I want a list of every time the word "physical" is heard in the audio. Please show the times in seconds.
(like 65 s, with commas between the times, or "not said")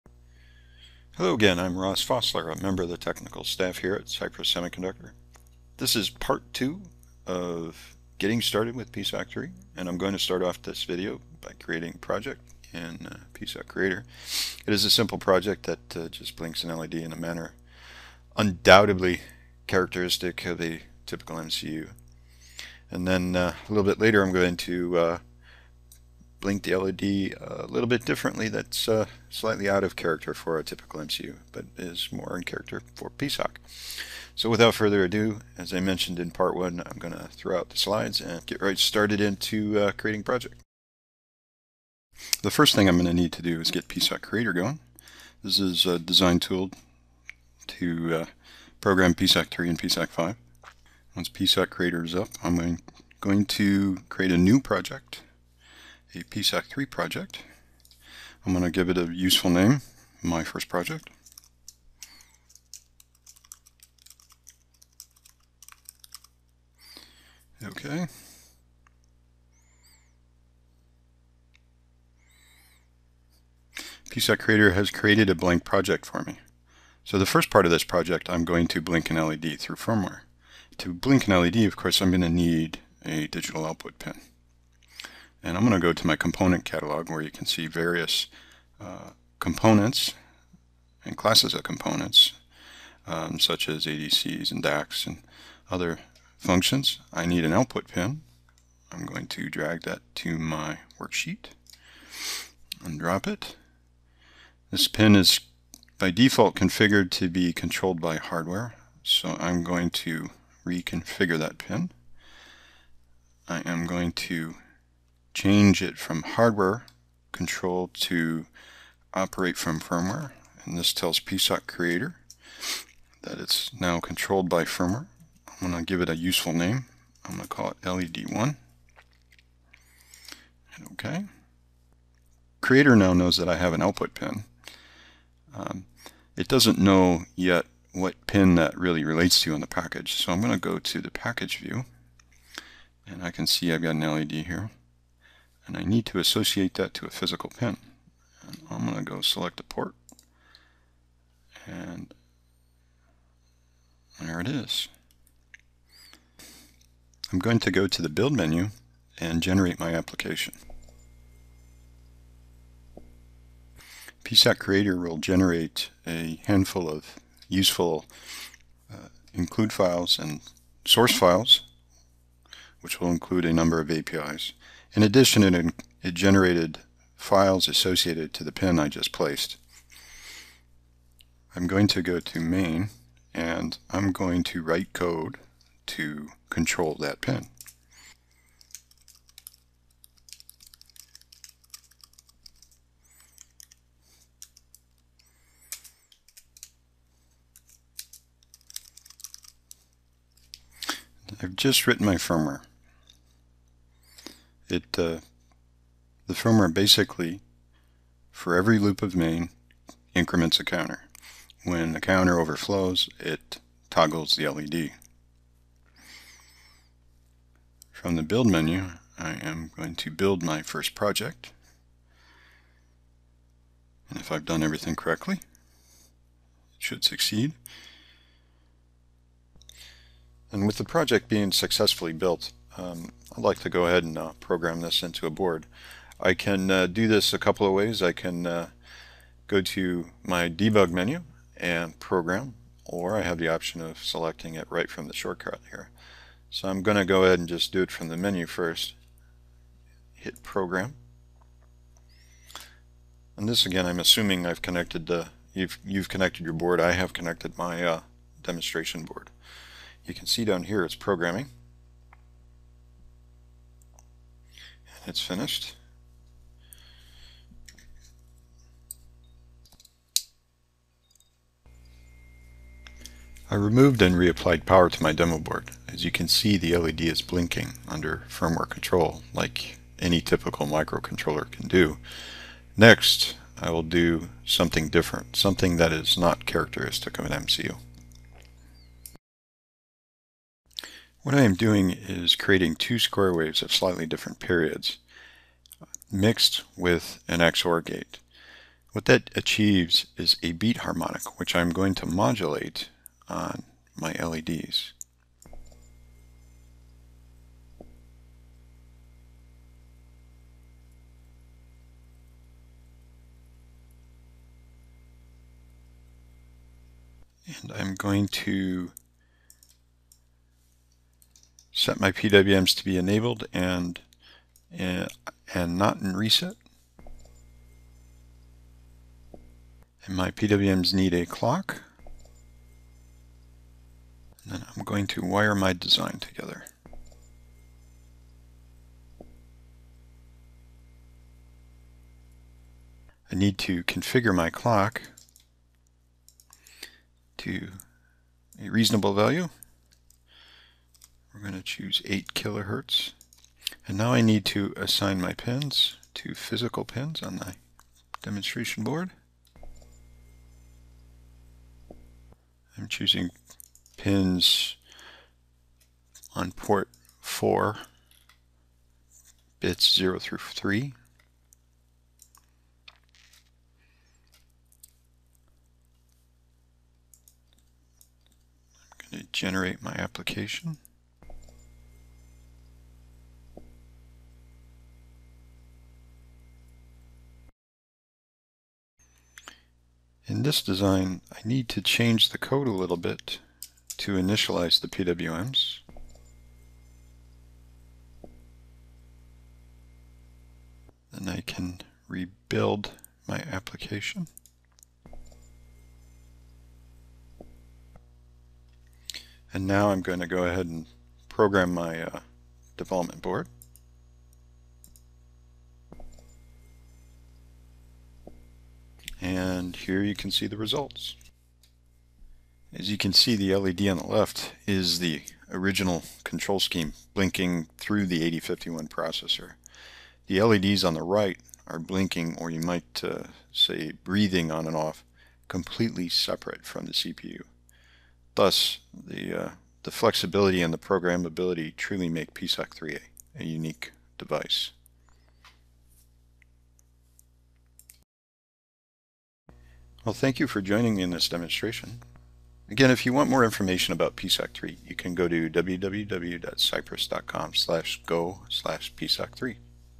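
147 s, 356 s.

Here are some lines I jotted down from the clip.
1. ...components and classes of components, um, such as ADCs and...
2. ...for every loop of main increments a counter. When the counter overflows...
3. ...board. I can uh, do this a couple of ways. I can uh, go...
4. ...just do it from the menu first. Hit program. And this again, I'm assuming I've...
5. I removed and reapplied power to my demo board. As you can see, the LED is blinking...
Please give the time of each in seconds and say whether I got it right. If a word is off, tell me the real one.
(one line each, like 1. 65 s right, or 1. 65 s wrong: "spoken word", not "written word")
1. 89 s right
2. 208 s right
3. 235 s right
4. 247 s right
5. 273 s right.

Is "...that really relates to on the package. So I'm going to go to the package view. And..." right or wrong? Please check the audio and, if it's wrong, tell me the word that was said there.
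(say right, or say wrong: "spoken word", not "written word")
right.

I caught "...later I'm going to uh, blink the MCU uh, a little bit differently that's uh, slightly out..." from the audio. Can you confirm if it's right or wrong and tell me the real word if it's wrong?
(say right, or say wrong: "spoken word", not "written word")
wrong: "LED", not "MCU".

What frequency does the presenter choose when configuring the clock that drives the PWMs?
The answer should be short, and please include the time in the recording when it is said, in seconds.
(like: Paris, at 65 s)
8 kilohertz, at 352 s.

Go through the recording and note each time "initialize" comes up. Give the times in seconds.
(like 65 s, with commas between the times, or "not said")
394 s.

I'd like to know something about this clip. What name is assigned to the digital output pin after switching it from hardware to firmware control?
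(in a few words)
LED1.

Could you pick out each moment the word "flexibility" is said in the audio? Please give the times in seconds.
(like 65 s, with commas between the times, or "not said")
439 s.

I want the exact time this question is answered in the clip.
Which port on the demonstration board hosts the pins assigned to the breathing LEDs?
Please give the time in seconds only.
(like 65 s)
366 s.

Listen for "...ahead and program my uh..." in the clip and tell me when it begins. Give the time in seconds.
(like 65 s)
410 s.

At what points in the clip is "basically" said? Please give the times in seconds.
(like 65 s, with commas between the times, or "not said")
206 s.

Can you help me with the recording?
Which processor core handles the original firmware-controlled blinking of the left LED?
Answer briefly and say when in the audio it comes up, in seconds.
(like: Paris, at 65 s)
8051, at 428 s.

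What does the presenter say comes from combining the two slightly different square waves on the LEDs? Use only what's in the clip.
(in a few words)
beat harmonic.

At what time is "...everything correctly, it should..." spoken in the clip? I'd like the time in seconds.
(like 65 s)
224 s.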